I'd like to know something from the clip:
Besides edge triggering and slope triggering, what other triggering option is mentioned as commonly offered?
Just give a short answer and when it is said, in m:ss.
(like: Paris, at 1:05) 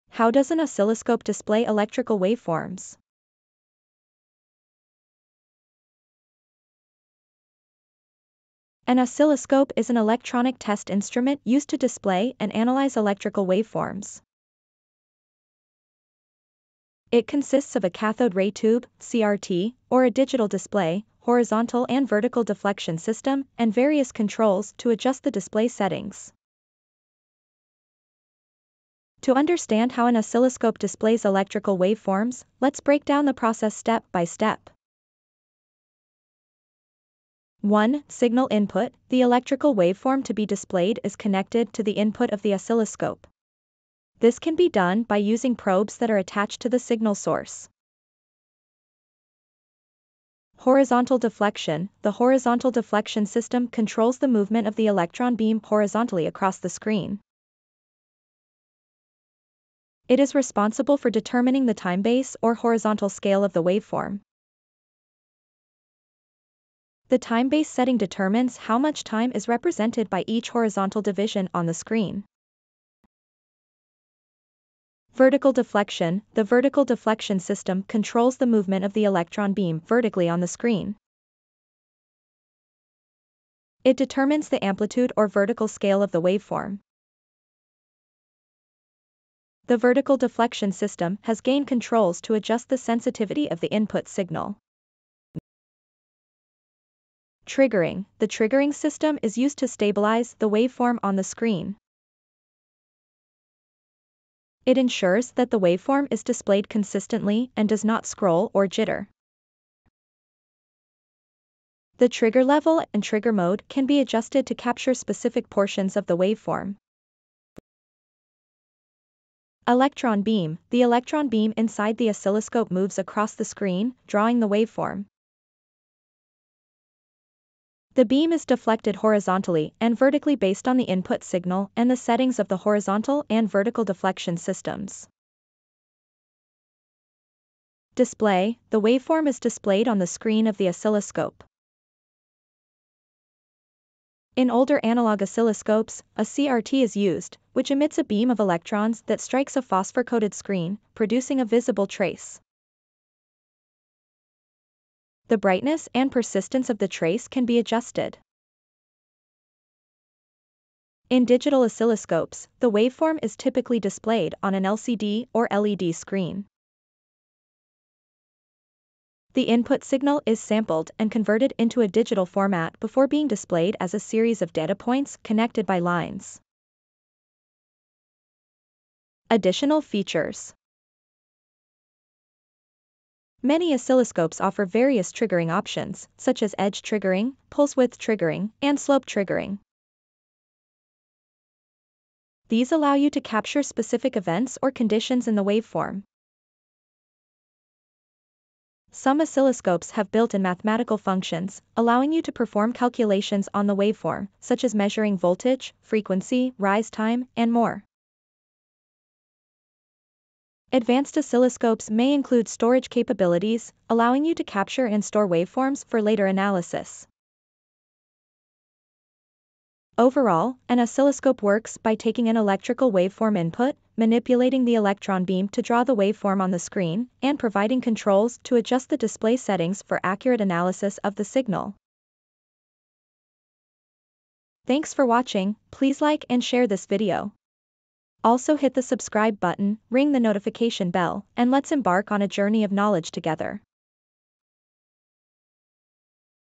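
Pulse width triggering, at 3:07.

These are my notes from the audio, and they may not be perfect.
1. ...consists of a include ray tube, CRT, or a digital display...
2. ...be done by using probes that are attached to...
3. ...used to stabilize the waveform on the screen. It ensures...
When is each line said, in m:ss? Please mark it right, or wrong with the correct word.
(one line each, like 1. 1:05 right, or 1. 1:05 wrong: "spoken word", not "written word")
1. 0:17 wrong: "cathode", not "include"
2. 0:44 right
3. 1:39 right.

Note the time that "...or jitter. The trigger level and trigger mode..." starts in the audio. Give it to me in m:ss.
1:48.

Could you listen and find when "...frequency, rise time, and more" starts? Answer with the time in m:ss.
3:25.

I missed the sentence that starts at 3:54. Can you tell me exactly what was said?
Thanks for watching, please like and share this video.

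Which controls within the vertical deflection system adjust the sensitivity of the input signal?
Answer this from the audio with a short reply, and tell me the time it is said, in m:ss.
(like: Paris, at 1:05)
Gain controls, at 1:31.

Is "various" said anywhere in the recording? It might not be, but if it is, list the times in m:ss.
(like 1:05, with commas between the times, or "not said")
0:23, 3:04.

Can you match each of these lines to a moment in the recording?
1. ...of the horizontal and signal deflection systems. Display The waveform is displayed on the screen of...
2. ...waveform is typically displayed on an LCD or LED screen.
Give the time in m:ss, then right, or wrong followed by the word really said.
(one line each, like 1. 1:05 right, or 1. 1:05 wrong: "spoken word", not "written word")
1. 2:12 wrong: "vertical", not "signal"
2. 2:42 right.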